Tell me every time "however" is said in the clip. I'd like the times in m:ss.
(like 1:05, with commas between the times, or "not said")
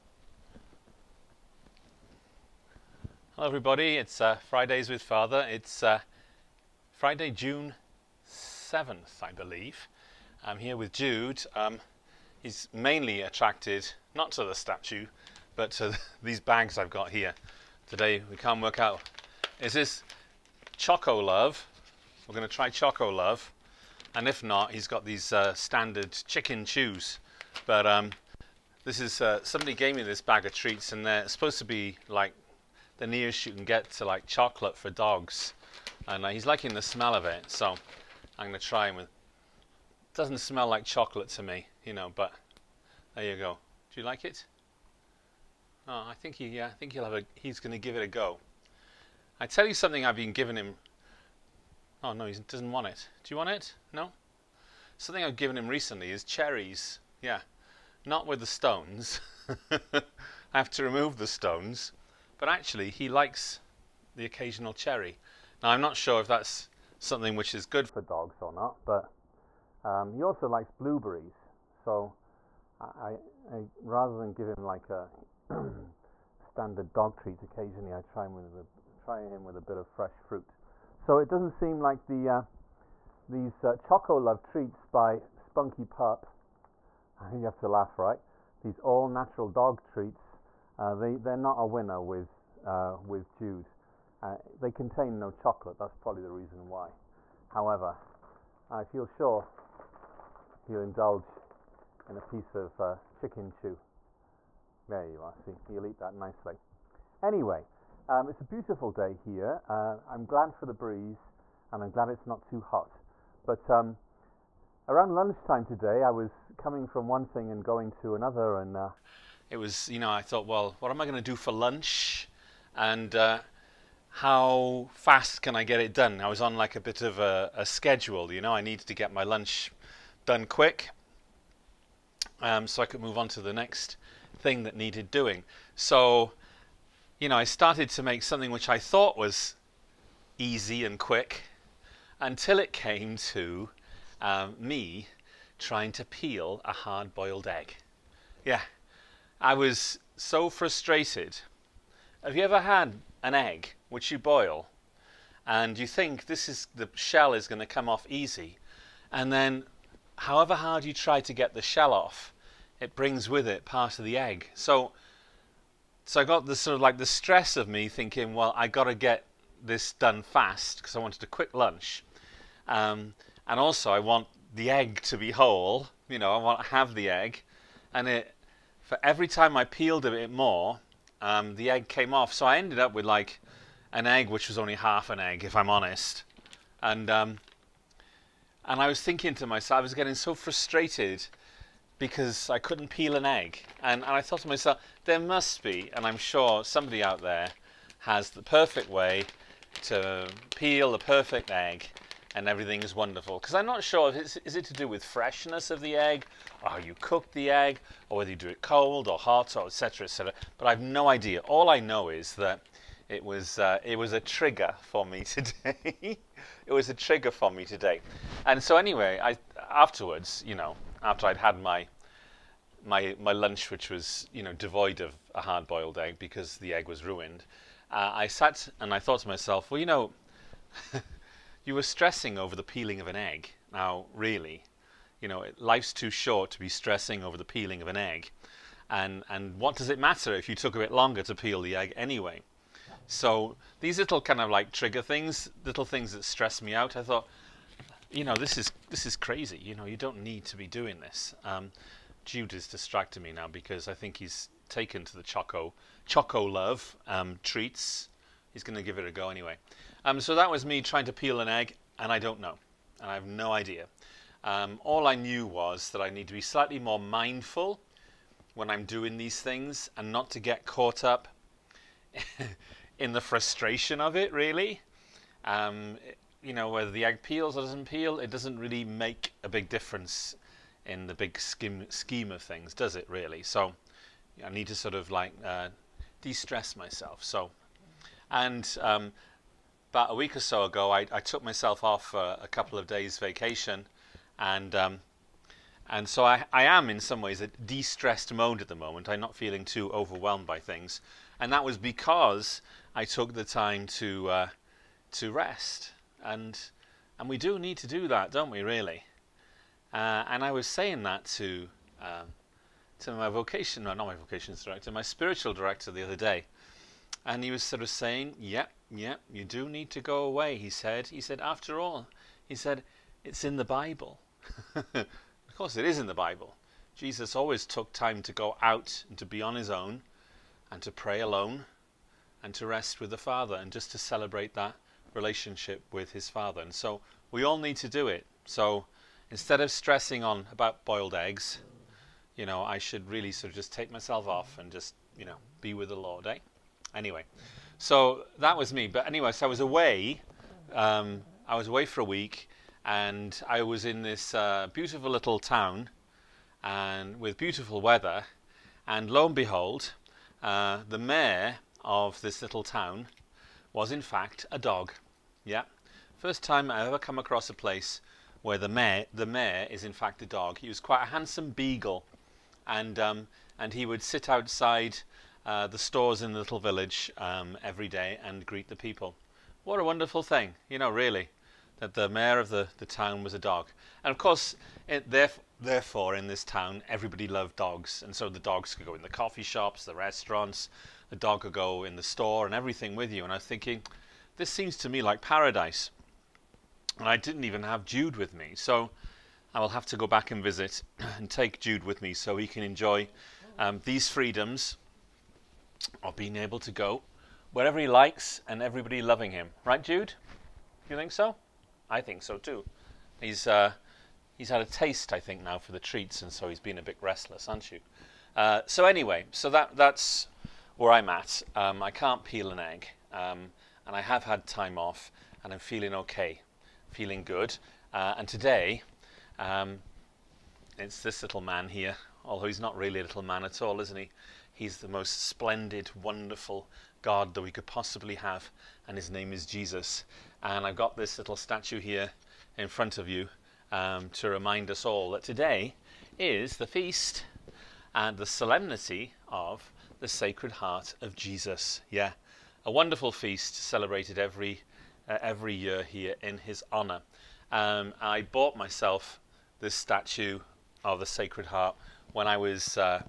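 1:37, 2:40.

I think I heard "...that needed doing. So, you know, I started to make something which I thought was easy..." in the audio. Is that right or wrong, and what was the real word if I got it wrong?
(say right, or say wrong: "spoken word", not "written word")
right.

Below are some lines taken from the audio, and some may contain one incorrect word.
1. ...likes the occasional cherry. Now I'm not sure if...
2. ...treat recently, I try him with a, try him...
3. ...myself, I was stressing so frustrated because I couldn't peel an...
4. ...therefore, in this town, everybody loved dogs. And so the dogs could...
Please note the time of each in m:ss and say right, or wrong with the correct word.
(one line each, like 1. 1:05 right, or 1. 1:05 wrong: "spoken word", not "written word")
1. 1:03 right
2. 1:17 wrong: "occasionally", not "recently"
3. 3:09 wrong: "getting", not "stressing"
4. 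6:25 right.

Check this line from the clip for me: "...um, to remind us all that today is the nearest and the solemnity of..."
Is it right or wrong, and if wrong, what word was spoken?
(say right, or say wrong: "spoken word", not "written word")
wrong: "feast", not "nearest".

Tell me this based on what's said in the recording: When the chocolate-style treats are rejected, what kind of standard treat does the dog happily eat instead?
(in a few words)
Chicken chew.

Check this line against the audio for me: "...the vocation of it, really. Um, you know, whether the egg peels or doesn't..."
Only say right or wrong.
wrong.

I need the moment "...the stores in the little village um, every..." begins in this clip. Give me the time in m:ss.
6:15.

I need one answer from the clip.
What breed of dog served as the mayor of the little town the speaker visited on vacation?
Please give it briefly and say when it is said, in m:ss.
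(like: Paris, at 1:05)
Beagle, at 6:11.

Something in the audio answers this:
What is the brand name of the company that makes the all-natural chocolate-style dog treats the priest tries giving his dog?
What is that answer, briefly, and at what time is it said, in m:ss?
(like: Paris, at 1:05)
Spunky Pup, at 1:25.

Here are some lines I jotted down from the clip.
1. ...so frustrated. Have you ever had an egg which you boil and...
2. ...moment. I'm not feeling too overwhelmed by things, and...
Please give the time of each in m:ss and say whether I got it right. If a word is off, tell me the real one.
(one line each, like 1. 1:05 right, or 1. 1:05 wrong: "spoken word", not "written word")
1. 2:30 right
2. 4:58 right.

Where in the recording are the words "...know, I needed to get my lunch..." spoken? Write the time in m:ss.
2:08.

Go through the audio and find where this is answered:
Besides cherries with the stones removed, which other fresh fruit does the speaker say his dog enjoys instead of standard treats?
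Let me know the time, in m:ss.
1:10.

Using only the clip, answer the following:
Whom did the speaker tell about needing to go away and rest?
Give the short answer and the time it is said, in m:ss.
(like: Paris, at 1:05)
Spiritual director, at 5:15.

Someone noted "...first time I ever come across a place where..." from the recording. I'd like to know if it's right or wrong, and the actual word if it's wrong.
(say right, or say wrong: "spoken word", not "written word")
right.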